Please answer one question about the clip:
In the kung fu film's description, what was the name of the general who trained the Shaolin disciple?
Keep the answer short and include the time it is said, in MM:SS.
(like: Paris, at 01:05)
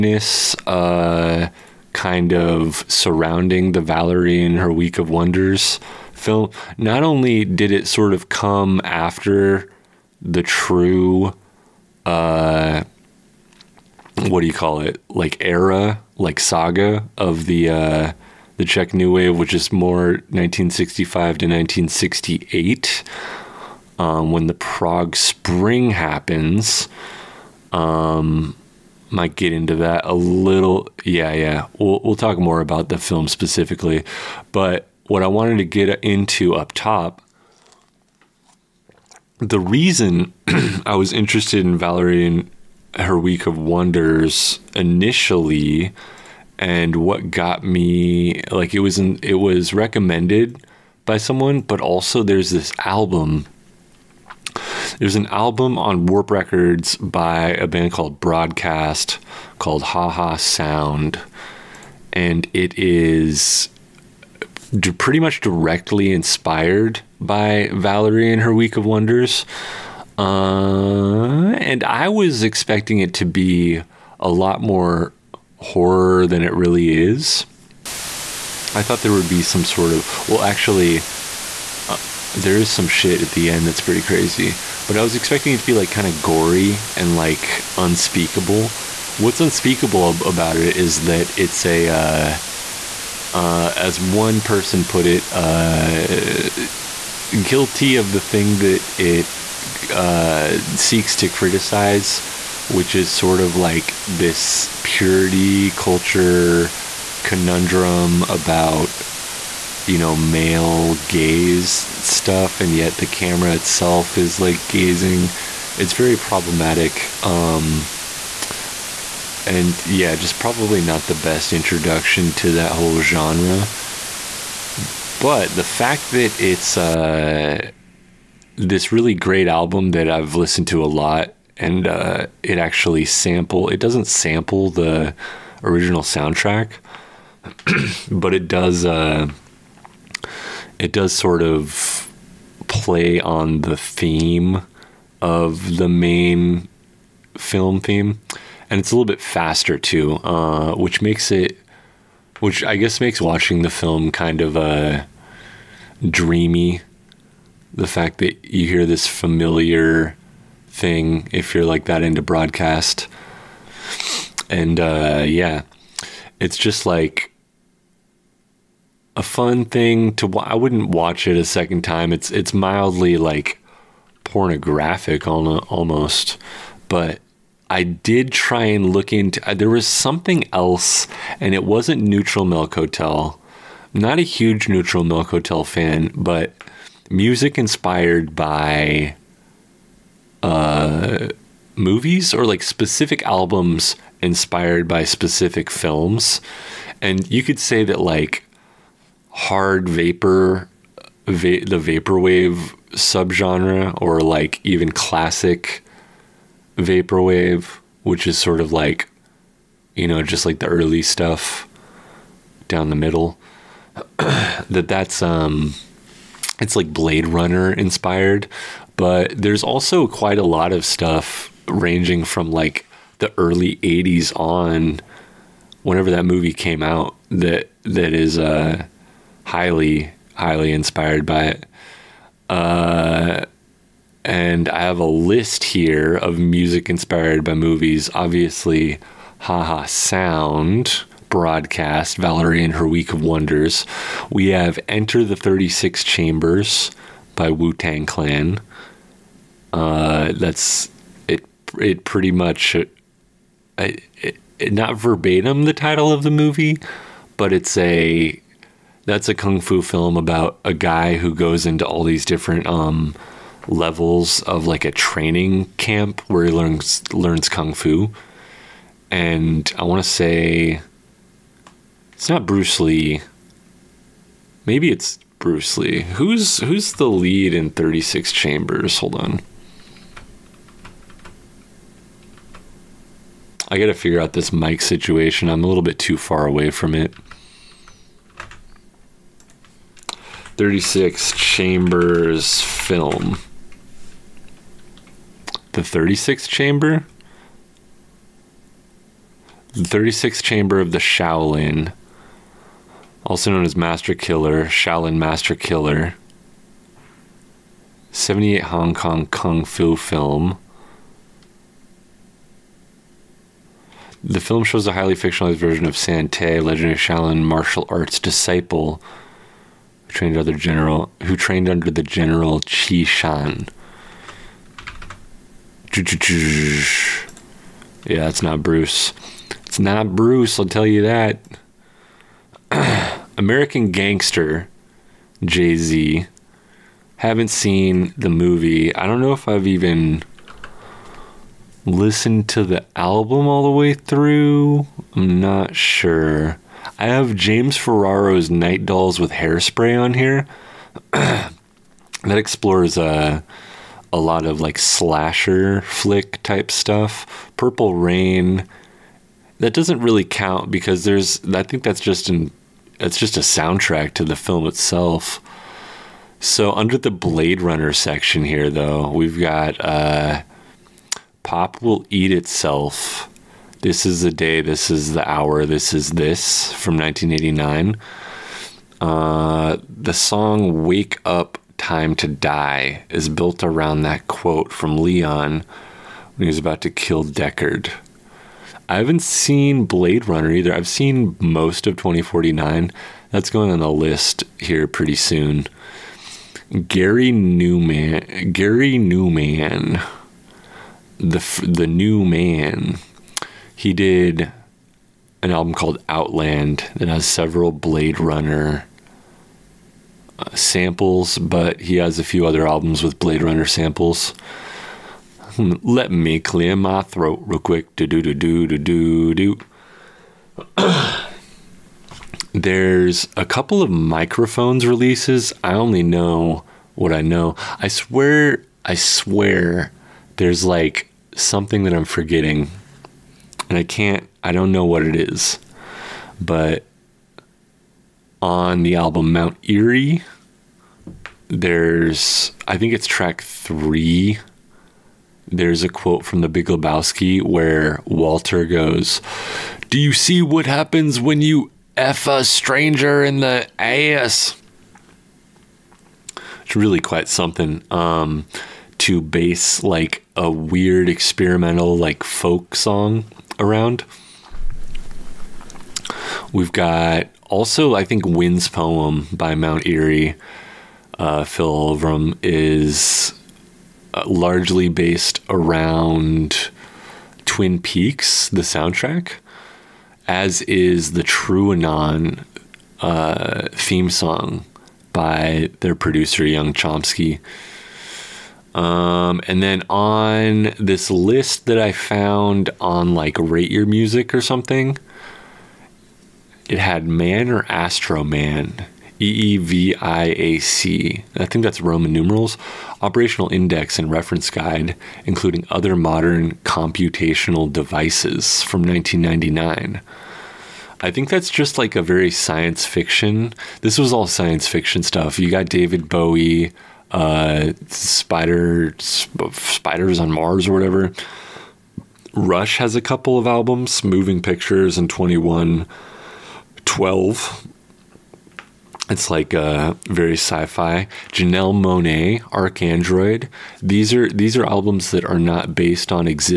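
Qi Shan, at 05:22.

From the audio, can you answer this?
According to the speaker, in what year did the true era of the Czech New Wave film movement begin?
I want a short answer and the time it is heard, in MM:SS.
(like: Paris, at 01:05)
1965, at 00:20.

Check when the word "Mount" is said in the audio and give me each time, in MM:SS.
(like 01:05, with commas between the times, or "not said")
07:19, 07:49.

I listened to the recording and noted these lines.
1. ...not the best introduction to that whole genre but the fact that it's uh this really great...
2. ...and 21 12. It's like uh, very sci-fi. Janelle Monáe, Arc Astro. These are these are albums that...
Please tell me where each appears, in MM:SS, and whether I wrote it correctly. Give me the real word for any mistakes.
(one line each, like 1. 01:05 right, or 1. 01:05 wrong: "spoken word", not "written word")
1. 02:00 right
2. 08:44 wrong: "Android", not "Astro".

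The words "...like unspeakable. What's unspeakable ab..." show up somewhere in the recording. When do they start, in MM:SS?
01:27.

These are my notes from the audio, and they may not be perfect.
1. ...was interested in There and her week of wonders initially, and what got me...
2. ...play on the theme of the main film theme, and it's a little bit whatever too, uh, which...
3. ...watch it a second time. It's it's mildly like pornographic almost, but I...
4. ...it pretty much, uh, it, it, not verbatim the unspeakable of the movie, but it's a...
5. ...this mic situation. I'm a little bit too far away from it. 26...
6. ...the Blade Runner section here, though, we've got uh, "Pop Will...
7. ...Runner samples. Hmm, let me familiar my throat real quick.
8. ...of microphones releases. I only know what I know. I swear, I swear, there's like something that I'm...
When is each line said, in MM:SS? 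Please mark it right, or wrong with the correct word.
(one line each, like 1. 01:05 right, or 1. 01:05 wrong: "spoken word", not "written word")
1. 00:40 wrong: "Valerie", not "There"
2. 02:22 wrong: "faster", not "whatever"
3. 02:50 right
4. 04:11 wrong: "title", not "unspeakable"
5. 04:44 wrong: "36", not "26"
6. 06:06 right
7. 06:53 wrong: "clear", not "familiar"
8. 07:03 right.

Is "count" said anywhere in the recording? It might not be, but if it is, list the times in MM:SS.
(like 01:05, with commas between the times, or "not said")
06:00.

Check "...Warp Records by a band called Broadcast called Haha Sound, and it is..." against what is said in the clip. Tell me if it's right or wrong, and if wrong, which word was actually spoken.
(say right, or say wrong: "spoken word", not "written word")
right.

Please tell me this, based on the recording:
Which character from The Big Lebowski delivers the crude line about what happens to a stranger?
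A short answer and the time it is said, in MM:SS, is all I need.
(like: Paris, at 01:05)
Walter, at 07:28.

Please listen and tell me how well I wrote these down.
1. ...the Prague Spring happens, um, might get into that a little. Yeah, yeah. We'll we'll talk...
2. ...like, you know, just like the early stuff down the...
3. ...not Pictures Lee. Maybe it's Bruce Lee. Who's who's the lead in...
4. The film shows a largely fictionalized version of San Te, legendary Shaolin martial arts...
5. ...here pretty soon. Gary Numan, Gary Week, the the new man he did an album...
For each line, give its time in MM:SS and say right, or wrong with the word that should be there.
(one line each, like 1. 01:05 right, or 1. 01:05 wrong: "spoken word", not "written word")
1. 00:24 right
2. 03:28 right
3. 04:32 wrong: "Bruce", not "Pictures"
4. 05:14 wrong: "highly", not "largely"
5. 06:34 wrong: "Numan", not "Week".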